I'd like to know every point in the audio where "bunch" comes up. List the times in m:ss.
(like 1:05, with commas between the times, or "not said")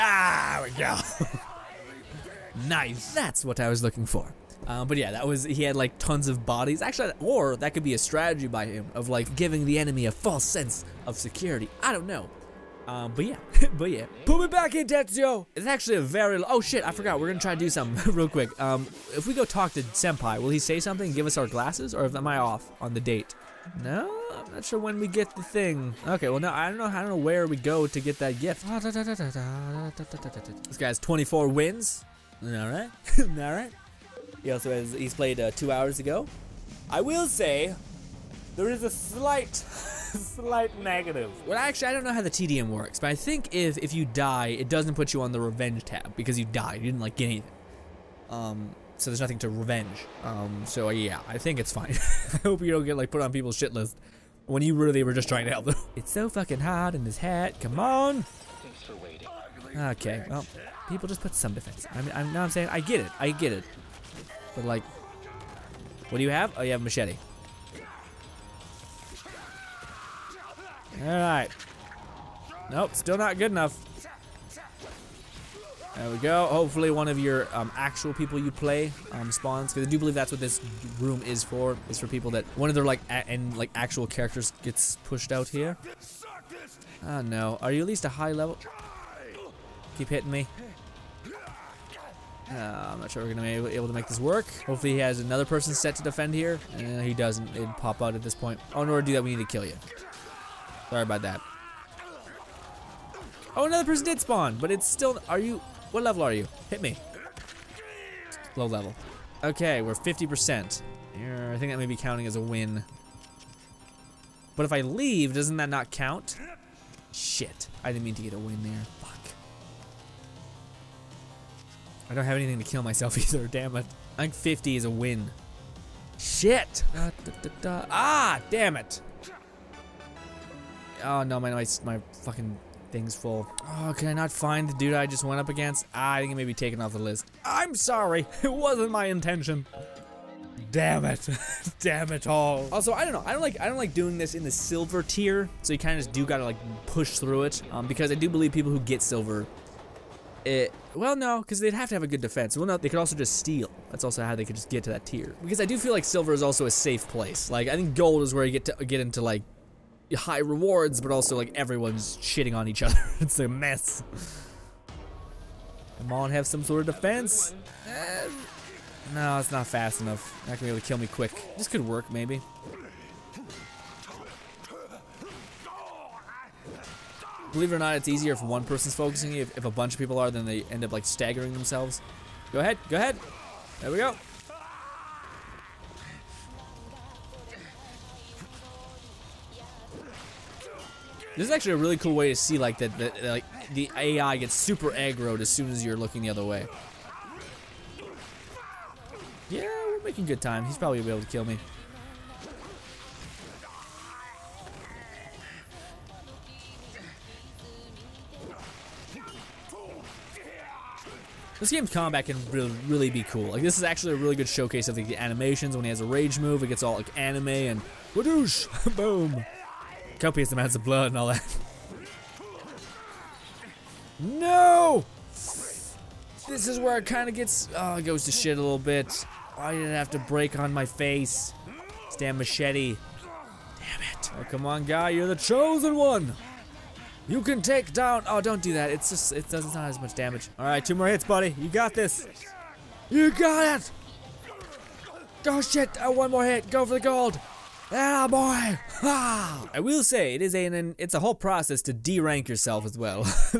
2:59.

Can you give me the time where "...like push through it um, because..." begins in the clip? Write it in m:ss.
2:26.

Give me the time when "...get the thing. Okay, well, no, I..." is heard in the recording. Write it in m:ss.
0:25.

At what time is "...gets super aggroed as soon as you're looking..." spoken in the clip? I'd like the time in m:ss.
3:14.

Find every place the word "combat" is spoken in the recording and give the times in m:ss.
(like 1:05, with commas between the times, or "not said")
3:31.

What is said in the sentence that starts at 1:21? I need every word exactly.
Is for people that one of their like and like actual characters gets pushed out here.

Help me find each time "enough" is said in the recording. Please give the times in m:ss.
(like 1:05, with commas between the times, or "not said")
1:13, 2:50.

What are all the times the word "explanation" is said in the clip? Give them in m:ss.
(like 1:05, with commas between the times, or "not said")
not said.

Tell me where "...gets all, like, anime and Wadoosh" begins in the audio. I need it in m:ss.
3:36.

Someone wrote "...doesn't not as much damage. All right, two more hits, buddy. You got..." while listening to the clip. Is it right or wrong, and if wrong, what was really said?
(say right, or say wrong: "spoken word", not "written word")
right.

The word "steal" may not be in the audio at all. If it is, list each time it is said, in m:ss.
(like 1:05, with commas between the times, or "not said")
2:33.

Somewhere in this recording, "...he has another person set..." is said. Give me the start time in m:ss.
1:34.